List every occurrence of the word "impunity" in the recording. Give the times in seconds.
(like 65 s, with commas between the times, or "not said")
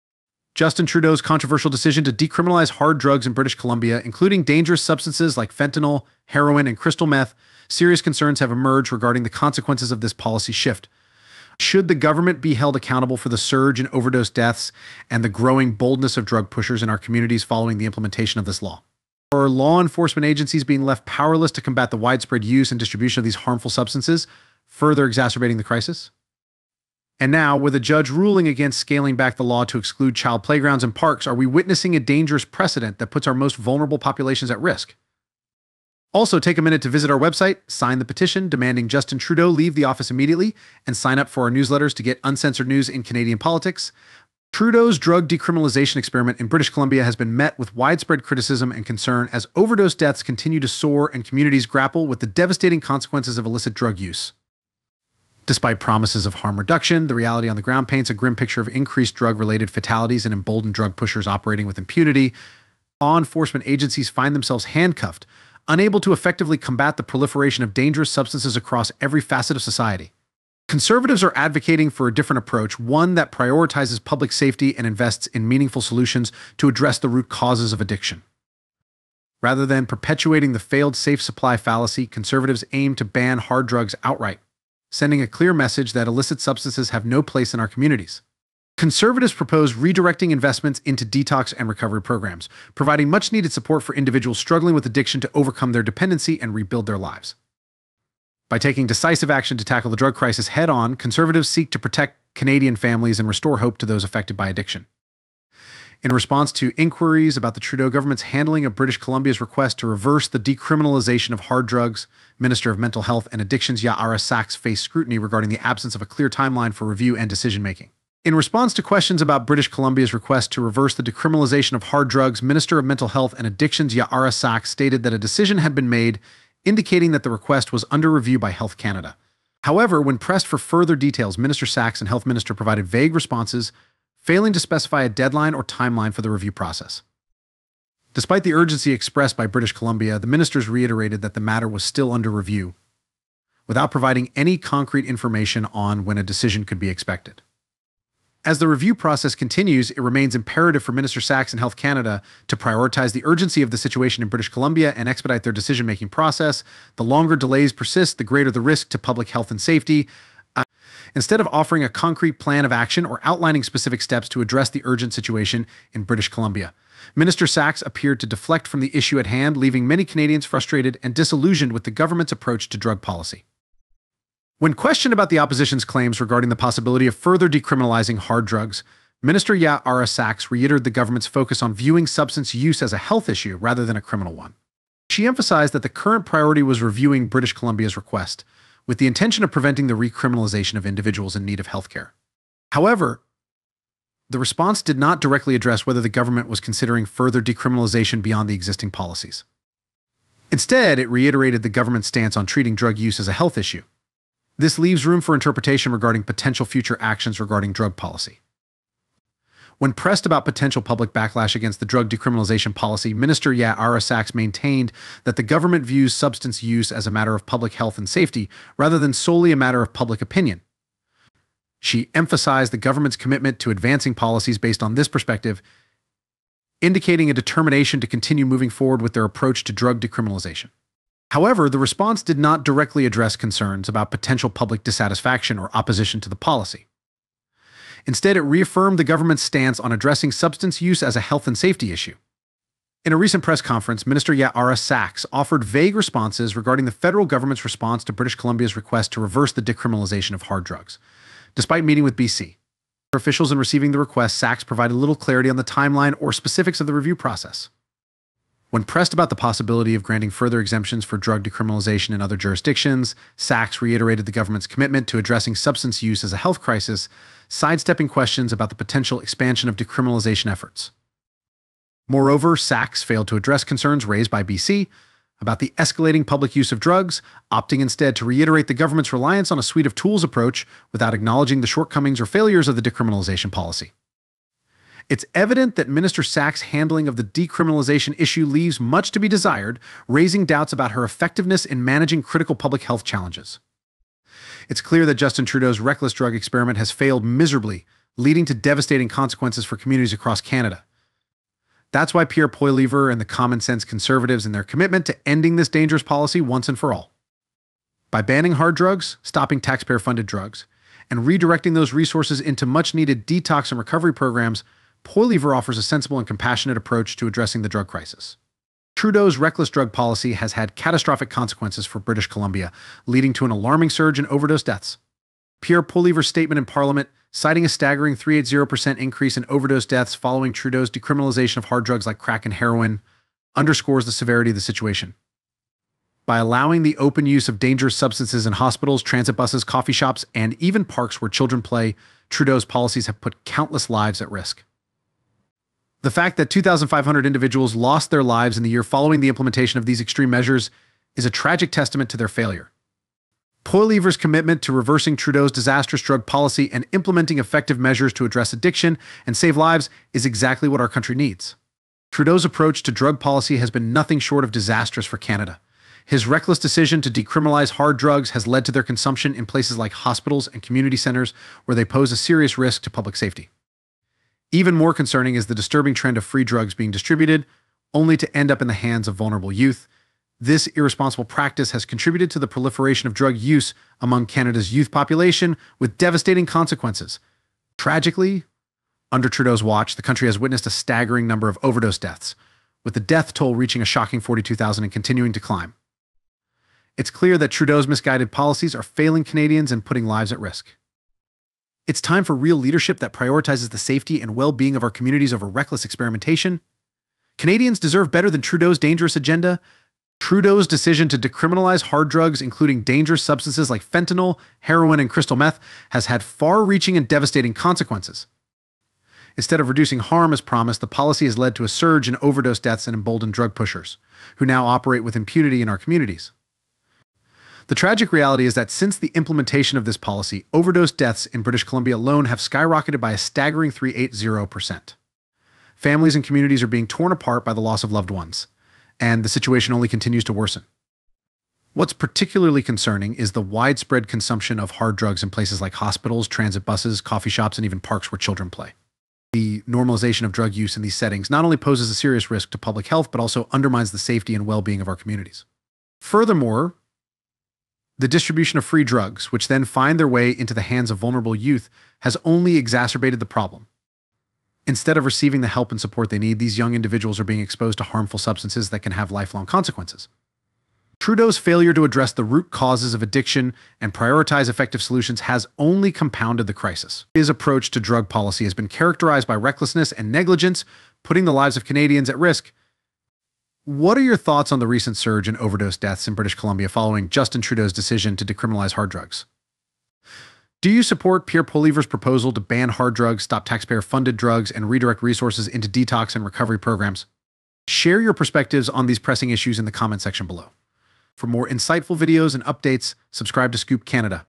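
61 s, 425 s.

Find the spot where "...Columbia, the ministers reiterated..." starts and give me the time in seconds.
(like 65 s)
139 s.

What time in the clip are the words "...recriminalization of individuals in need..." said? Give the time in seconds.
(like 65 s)
189 s.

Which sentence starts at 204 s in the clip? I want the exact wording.
This leaves room for interpretation regarding potential future actions regarding drug policy.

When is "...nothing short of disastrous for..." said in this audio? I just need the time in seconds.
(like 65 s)
363 s.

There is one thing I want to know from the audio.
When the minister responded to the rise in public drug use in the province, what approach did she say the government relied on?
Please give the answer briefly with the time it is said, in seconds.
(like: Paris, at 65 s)
a suite of tools, at 279 s.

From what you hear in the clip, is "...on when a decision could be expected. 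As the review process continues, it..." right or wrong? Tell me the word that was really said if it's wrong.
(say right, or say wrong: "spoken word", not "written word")
right.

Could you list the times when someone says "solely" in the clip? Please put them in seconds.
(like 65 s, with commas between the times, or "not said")
219 s.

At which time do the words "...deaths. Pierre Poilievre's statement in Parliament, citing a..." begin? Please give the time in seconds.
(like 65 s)
324 s.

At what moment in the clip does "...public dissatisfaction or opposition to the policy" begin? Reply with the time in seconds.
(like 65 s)
234 s.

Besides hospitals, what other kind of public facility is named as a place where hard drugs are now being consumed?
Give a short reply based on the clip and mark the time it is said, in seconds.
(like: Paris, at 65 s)
community centers, at 370 s.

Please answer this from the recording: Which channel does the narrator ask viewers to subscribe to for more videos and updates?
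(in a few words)
Scoop Canada.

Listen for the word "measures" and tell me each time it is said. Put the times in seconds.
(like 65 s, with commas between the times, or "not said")
350 s, 357 s.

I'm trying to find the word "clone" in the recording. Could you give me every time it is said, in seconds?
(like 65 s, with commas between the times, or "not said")
not said.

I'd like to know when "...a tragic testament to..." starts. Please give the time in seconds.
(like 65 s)
351 s.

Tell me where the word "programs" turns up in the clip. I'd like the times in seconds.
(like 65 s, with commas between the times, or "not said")
92 s, 314 s, 496 s.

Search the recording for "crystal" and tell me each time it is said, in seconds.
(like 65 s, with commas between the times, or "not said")
6 s, 415 s.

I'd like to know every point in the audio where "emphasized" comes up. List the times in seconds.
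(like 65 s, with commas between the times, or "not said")
185 s, 222 s.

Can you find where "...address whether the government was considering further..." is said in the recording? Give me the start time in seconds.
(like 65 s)
195 s.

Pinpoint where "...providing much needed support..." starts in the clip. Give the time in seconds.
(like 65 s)
92 s.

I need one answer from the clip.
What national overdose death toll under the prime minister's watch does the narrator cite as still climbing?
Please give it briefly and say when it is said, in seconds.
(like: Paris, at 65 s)
42,000, at 394 s.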